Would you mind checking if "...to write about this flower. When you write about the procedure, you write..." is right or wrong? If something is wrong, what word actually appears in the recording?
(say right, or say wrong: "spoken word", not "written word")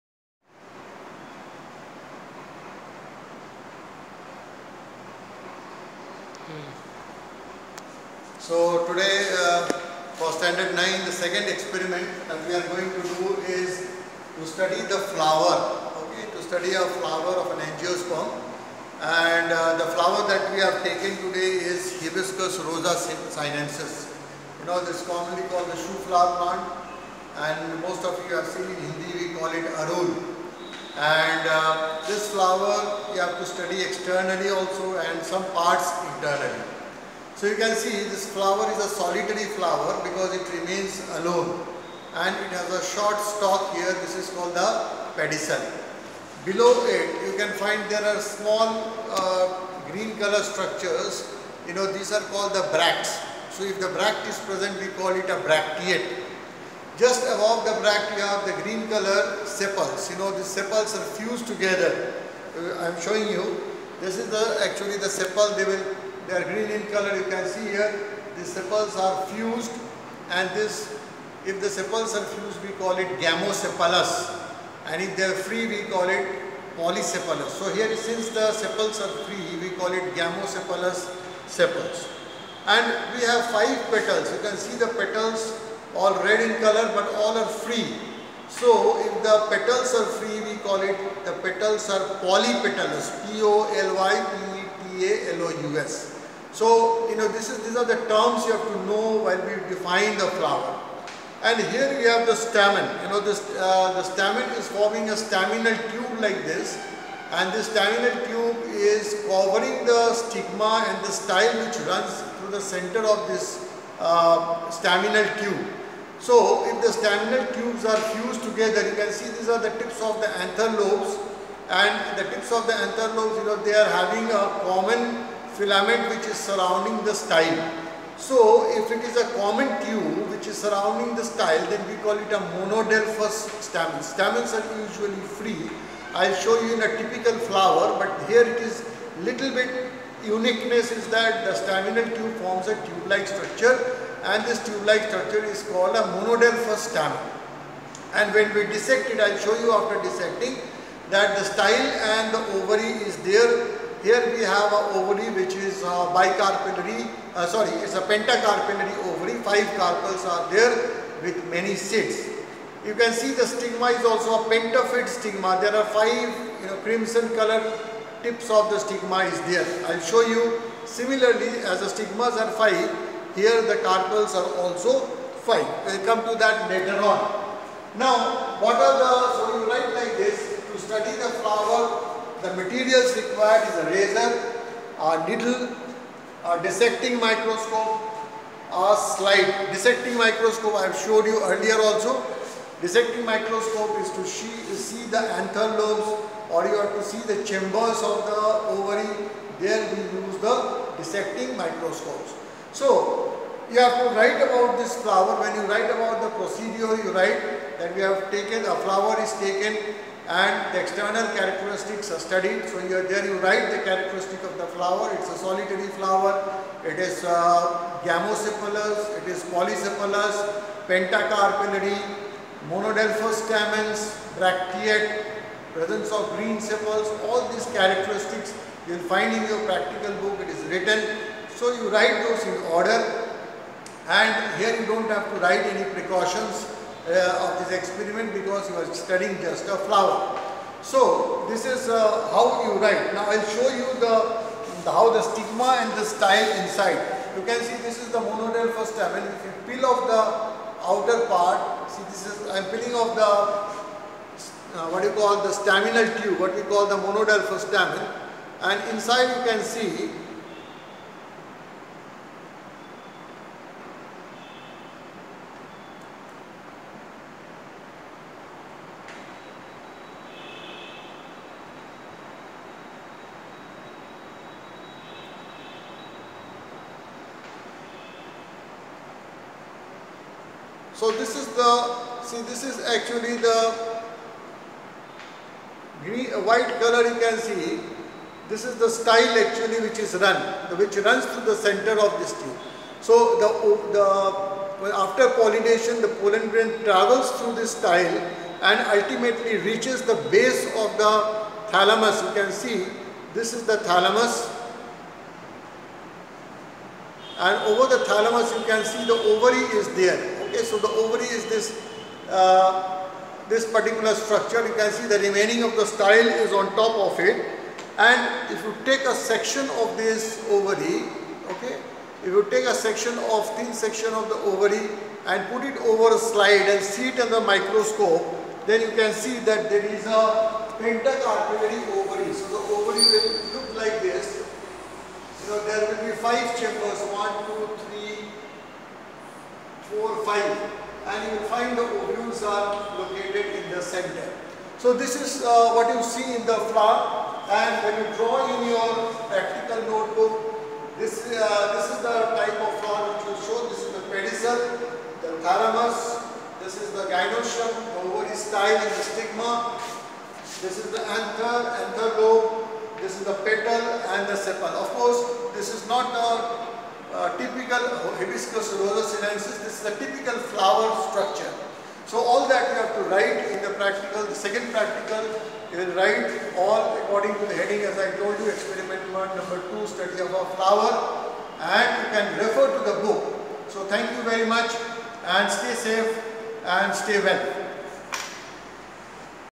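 right.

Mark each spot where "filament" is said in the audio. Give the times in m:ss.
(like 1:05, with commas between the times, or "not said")
2:05.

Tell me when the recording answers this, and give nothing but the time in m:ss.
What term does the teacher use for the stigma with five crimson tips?
2:44.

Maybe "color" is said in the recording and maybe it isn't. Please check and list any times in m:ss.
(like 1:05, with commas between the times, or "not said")
0:50, 0:58, 1:06, 1:26, 2:47, 4:46.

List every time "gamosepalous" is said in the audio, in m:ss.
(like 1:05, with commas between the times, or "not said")
1:13, 1:20.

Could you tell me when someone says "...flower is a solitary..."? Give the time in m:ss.
0:38.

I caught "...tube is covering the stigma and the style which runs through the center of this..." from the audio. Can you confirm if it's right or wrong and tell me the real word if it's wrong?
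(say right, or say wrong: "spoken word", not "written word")
right.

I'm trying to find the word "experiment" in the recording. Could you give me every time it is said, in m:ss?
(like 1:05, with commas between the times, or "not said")
0:11, 3:57, 6:18.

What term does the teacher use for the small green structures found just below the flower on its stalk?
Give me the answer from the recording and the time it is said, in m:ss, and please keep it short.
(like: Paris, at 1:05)
bracts, at 0:52.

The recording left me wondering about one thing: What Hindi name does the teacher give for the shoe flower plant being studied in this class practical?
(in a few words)
arul.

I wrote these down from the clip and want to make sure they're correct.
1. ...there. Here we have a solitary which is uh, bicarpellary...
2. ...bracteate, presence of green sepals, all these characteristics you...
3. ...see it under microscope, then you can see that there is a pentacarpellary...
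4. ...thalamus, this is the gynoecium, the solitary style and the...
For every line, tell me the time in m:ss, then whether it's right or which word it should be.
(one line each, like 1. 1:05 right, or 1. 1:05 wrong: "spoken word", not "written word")
1. 2:33 wrong: "ovary", not "solitary"
2. 3:44 right
3. 5:26 right
4. 5:55 wrong: "ovary", not "solitary".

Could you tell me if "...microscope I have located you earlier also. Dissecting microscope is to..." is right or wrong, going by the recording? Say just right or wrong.
wrong.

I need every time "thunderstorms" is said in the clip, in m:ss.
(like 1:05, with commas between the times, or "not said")
not said.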